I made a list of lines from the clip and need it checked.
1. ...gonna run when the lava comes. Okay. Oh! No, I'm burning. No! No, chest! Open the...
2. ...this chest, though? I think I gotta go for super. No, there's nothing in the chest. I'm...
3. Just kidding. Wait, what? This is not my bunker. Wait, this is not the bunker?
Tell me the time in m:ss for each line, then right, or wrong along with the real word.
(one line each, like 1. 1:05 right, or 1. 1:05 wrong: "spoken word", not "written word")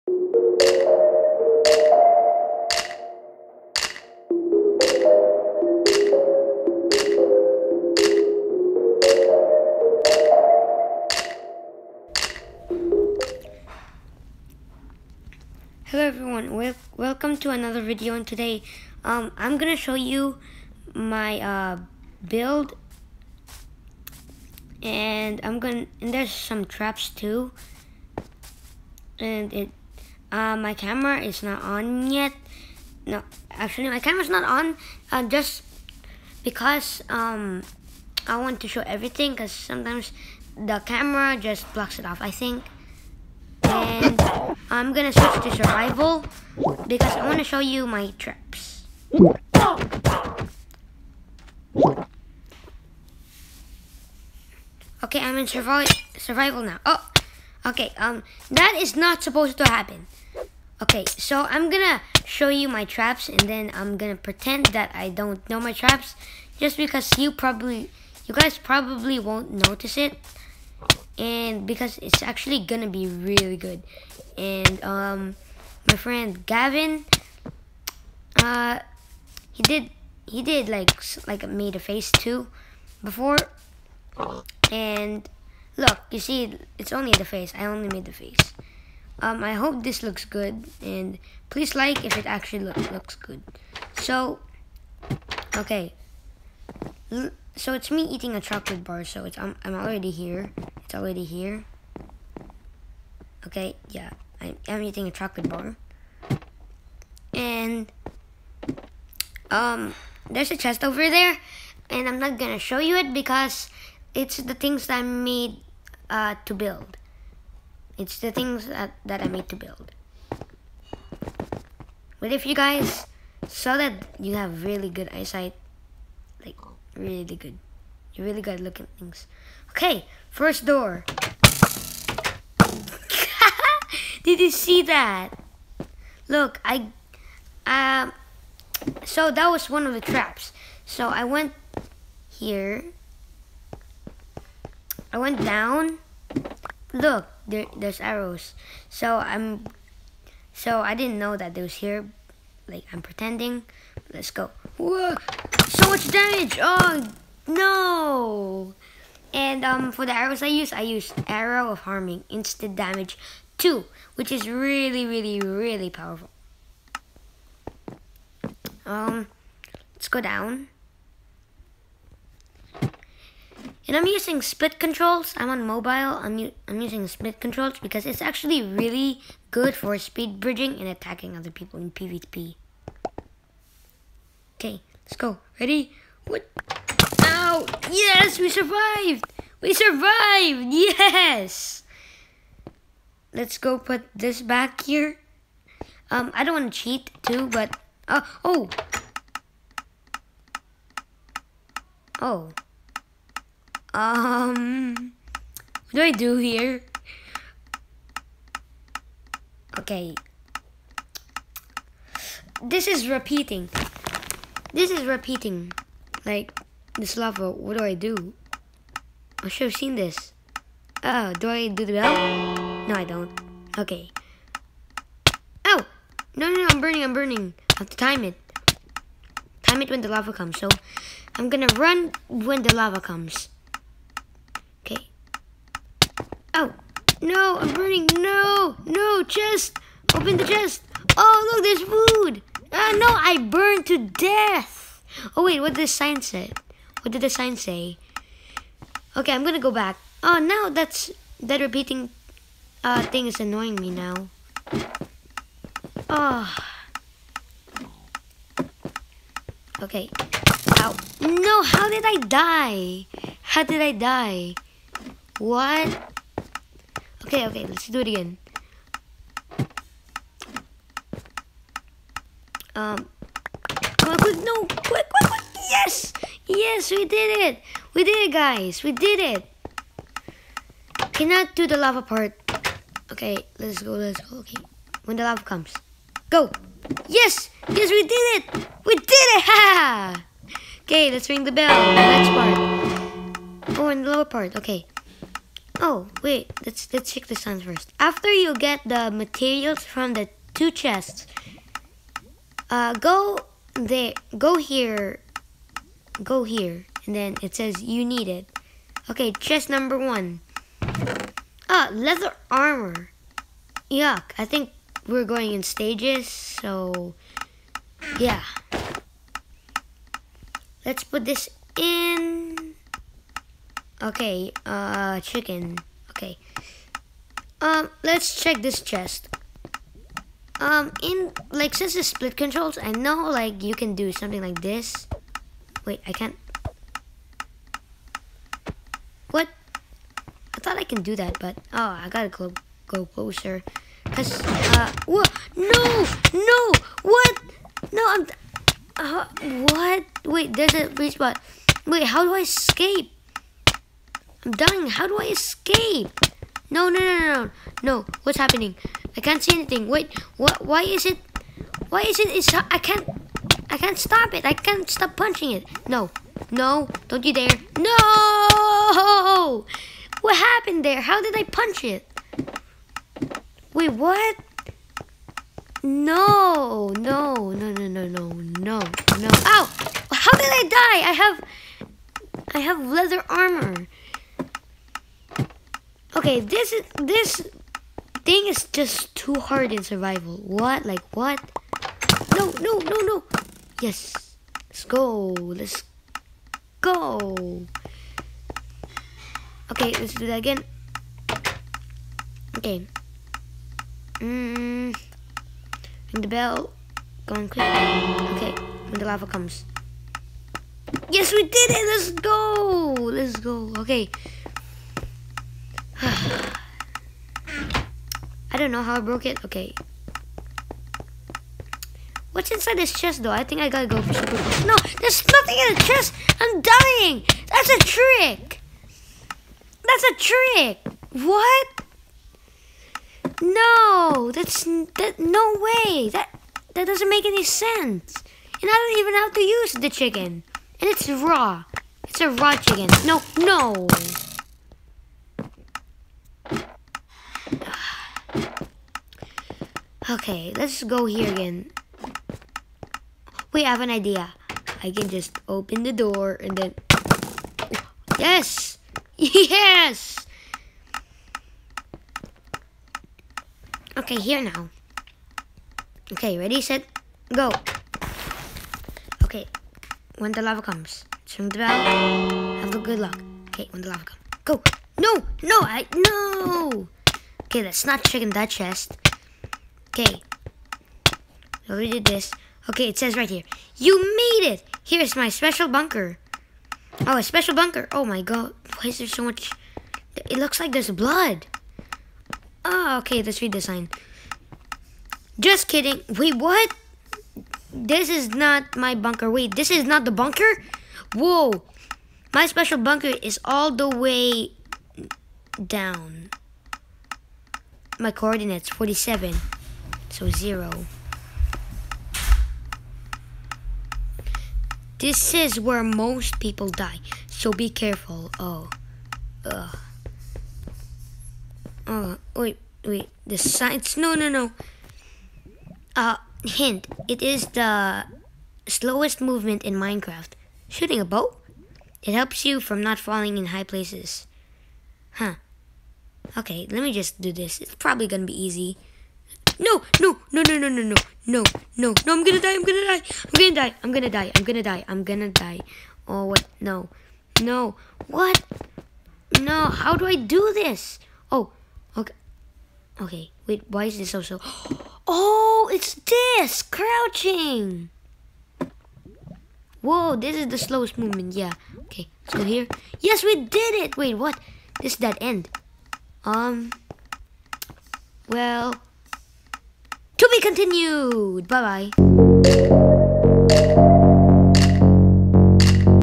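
1. 3:51 right
2. 7:02 right
3. 8:15 right.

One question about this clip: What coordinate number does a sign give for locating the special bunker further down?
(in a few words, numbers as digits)
47.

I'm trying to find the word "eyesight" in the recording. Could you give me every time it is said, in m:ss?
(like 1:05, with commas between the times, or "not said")
2:05.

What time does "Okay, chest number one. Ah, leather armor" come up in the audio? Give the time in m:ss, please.
5:09.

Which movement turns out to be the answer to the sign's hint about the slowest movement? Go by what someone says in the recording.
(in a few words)
Crouching.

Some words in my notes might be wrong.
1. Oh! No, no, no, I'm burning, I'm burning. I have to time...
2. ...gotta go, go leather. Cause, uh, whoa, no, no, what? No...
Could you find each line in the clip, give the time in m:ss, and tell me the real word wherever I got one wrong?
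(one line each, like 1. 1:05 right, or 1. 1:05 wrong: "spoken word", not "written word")
1. 3:45 right
2. 5:42 wrong: "closer", not "leather".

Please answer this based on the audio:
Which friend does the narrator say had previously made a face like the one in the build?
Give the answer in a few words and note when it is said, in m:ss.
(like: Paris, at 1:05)
Gavin, at 1:16.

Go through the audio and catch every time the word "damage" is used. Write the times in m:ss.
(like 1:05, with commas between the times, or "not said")
2:36, 2:42.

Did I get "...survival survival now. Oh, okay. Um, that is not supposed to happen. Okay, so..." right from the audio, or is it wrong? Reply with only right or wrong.
right.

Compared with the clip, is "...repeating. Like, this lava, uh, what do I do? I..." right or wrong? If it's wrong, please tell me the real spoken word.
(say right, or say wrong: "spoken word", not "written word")
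right.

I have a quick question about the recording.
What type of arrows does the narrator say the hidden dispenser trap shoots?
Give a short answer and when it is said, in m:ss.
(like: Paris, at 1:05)
Arrow of Harming, at 2:41.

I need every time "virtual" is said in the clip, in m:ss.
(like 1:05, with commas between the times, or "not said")
not said.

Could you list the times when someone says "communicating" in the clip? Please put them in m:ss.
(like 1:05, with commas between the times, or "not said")
not said.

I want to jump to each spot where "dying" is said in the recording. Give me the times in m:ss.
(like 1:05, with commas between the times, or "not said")
5:54, 7:06.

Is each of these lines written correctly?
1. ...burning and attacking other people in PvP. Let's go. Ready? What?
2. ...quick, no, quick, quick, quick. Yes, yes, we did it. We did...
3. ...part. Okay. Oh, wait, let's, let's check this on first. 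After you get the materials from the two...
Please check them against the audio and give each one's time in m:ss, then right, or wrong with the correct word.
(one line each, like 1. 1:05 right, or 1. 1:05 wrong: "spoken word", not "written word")
1. 3:00 wrong: "bridging", not "burning"
2. 4:34 right
3. 4:54 right.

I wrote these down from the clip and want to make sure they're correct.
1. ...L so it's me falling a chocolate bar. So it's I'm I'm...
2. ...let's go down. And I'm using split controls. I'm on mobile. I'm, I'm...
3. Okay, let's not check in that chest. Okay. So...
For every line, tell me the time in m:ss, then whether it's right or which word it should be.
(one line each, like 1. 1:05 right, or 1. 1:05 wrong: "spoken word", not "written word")
1. 1:37 wrong: "eating", not "falling"
2. 2:49 right
3. 7:57 right.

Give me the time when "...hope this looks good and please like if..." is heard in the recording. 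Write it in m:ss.
1:29.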